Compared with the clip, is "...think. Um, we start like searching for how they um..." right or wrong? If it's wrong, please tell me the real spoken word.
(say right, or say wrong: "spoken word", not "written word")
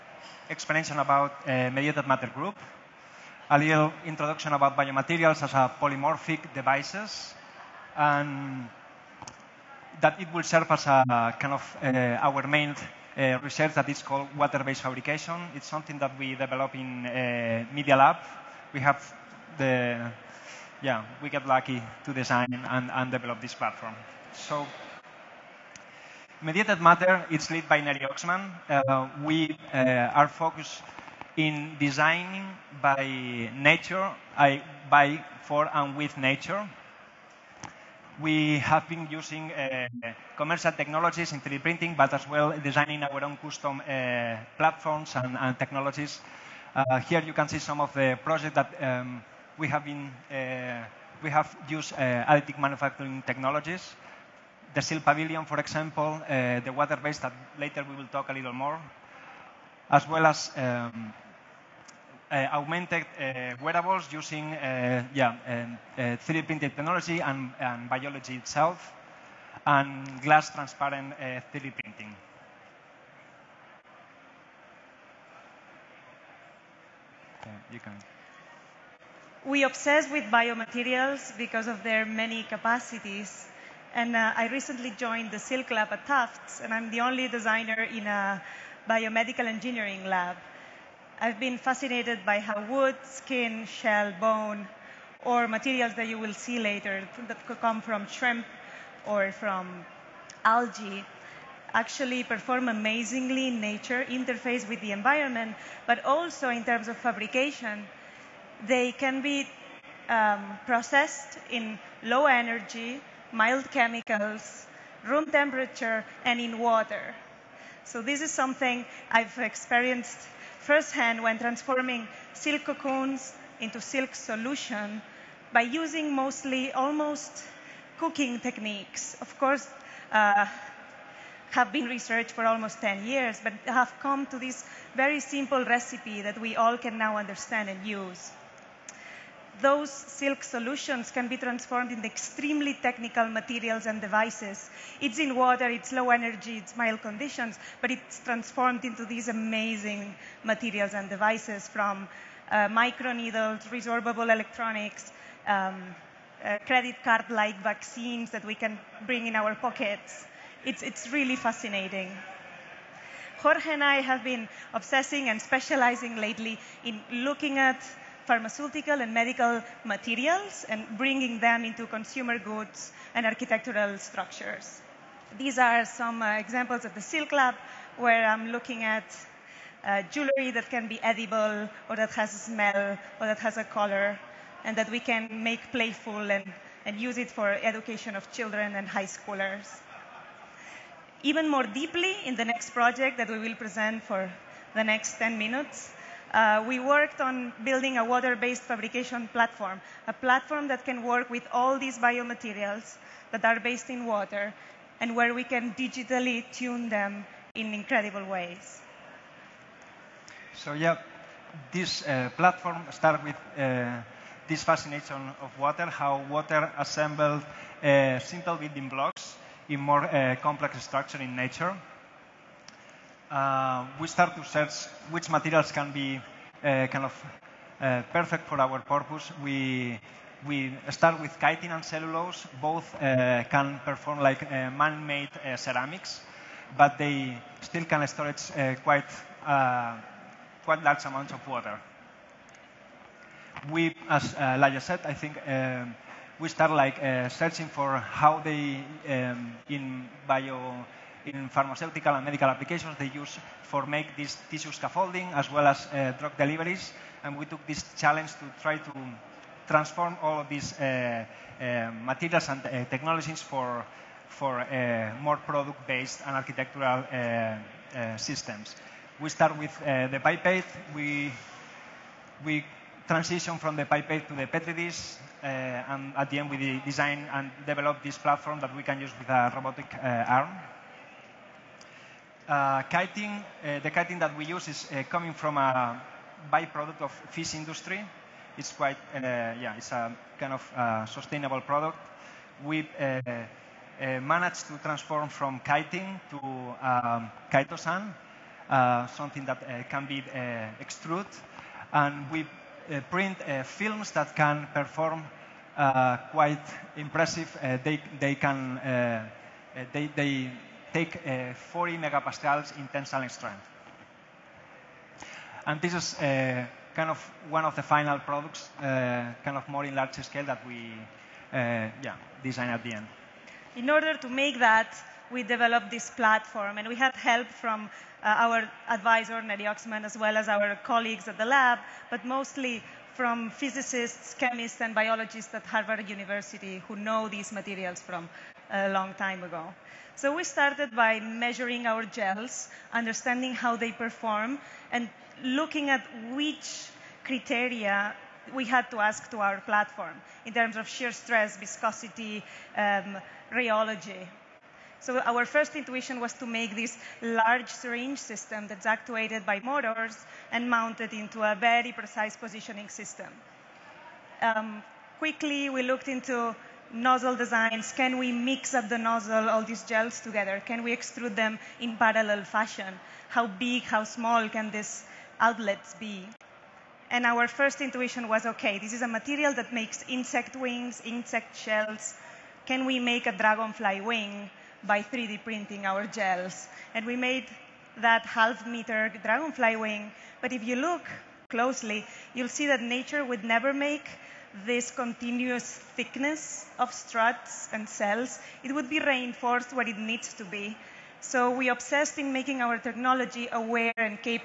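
right.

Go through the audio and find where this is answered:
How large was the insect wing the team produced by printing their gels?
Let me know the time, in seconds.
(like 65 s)
388 s.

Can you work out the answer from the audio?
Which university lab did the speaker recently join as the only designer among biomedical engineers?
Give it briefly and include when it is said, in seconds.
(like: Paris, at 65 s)
Silk Lab at Tufts, at 85 s.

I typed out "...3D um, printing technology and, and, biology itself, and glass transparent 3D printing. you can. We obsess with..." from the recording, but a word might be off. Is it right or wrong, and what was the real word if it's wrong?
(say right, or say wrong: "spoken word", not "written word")
right.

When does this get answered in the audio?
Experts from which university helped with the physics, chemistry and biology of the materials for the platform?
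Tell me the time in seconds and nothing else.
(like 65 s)
335 s.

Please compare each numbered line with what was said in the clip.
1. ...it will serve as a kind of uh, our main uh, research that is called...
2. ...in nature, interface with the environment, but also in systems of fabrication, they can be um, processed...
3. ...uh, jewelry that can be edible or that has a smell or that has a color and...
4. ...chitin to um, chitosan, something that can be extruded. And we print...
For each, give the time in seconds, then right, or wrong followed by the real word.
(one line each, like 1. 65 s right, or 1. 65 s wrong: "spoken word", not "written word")
1. 10 s right
2. 103 s wrong: "terms", not "systems"
3. 179 s right
4. 295 s right.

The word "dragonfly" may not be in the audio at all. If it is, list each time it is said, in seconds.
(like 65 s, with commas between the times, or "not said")
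383 s, 389 s.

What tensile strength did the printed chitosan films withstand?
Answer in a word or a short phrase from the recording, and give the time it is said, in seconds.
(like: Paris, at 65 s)
40 megapascals, at 311 s.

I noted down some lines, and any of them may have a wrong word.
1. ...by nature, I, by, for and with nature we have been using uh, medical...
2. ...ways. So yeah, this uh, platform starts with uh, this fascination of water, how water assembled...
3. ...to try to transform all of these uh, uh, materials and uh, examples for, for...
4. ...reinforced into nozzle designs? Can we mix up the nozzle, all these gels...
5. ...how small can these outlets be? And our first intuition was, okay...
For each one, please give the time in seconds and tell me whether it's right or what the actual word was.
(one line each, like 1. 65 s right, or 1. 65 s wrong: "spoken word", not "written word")
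1. 32 s wrong: "commercial", not "medical"
2. 208 s right
3. 258 s wrong: "technologies", not "examples"
4. 365 s wrong: "looked", not "reinforced"
5. 373 s right.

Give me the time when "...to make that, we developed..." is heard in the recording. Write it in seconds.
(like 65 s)
324 s.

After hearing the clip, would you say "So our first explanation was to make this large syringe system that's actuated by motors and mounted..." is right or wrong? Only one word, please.
wrong.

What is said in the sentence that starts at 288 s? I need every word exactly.
It's quite, uh, yeah, it's a kind of uh, sustainable product.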